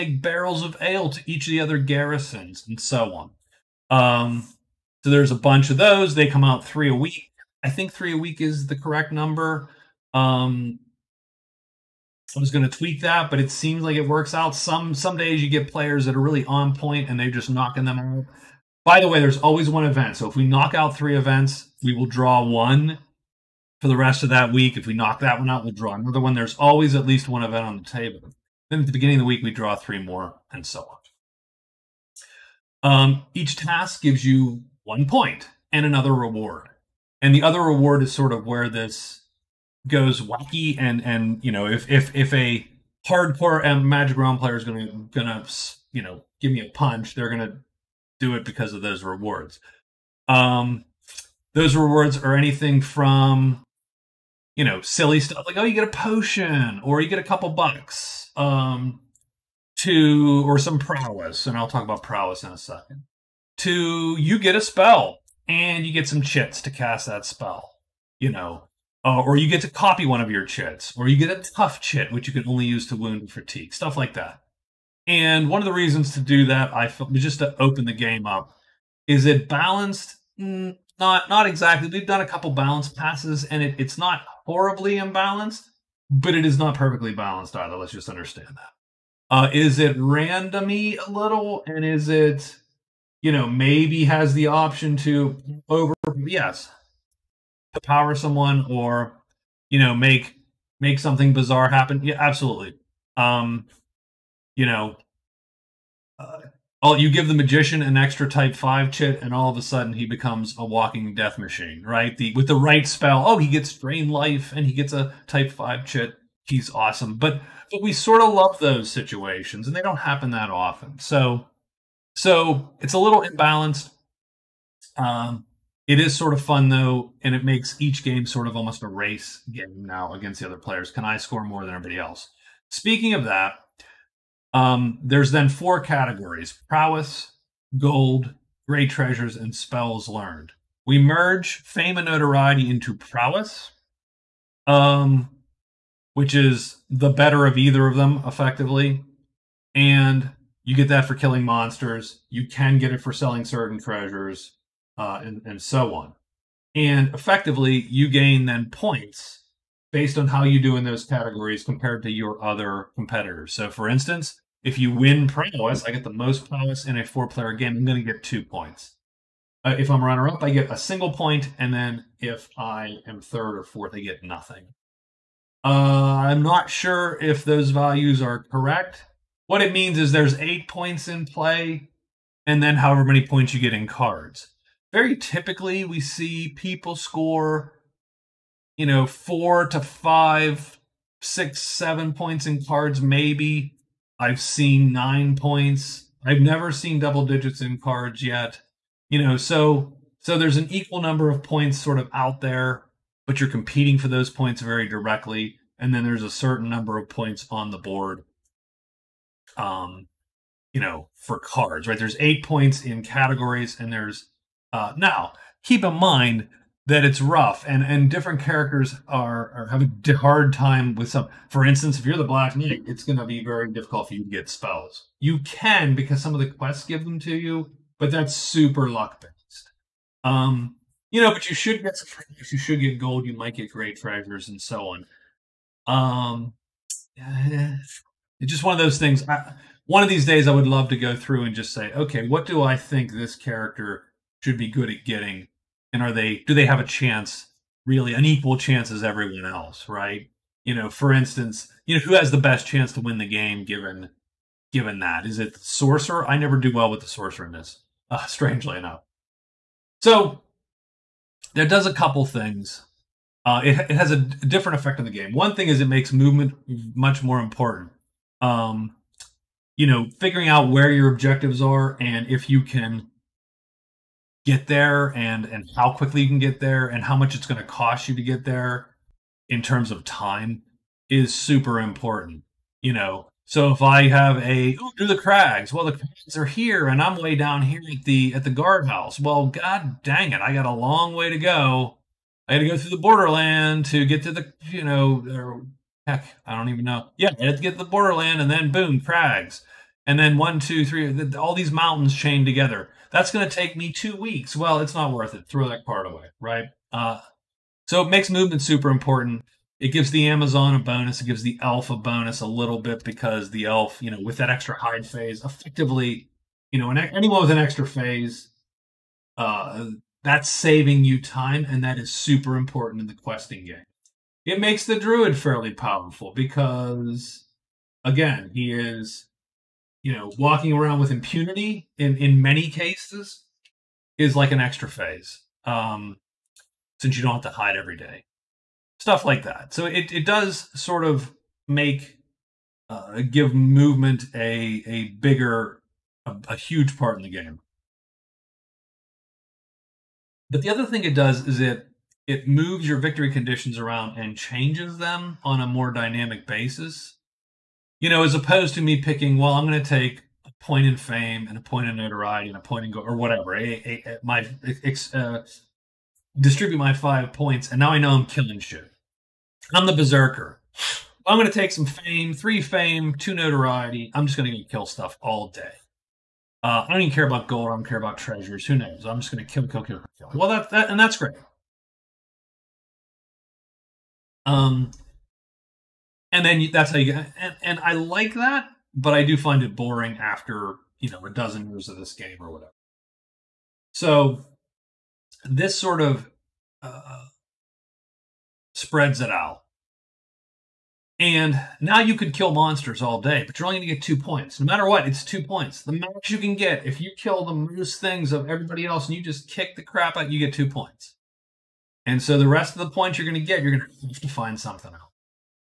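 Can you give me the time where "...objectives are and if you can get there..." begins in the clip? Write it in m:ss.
4:31.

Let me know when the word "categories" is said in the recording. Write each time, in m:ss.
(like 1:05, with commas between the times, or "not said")
2:15, 2:41, 3:33.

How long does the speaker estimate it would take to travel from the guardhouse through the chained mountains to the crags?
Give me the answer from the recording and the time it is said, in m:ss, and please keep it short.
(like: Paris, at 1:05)
2 weeks, at 5:03.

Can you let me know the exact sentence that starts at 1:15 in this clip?
And one of the reasons to do that, I felt, was just to open the game up.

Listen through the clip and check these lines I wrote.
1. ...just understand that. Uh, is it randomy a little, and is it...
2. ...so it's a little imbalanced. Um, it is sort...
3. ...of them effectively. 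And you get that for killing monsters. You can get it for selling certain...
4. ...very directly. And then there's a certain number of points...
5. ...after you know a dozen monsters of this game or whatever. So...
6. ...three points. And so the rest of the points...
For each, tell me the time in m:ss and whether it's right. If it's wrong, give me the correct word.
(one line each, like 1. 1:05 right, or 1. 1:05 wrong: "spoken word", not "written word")
1. 1:27 right
2. 2:02 right
3. 2:27 right
4. 3:24 right
5. 6:30 wrong: "years", not "monsters"
6. 6:50 wrong: "two", not "three".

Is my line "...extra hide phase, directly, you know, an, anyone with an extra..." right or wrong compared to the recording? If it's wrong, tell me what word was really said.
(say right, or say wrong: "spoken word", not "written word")
wrong: "effectively", not "directly".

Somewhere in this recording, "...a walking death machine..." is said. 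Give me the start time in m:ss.
1:50.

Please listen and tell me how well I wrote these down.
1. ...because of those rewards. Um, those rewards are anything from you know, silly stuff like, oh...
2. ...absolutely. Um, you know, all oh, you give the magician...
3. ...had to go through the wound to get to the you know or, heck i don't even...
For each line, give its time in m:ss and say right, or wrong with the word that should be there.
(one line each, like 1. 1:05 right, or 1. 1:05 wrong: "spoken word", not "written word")
1. 0:48 right
2. 1:42 right
3. 4:52 wrong: "borderland", not "wound".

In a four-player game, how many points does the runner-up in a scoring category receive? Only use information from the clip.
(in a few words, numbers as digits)
1.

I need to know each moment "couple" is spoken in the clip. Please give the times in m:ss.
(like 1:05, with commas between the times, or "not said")
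0:57, 1:22, 4:21.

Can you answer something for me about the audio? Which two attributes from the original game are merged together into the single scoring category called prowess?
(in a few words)
fame and notoriety.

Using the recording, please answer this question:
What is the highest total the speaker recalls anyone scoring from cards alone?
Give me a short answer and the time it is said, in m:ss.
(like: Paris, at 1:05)
9, at 3:14.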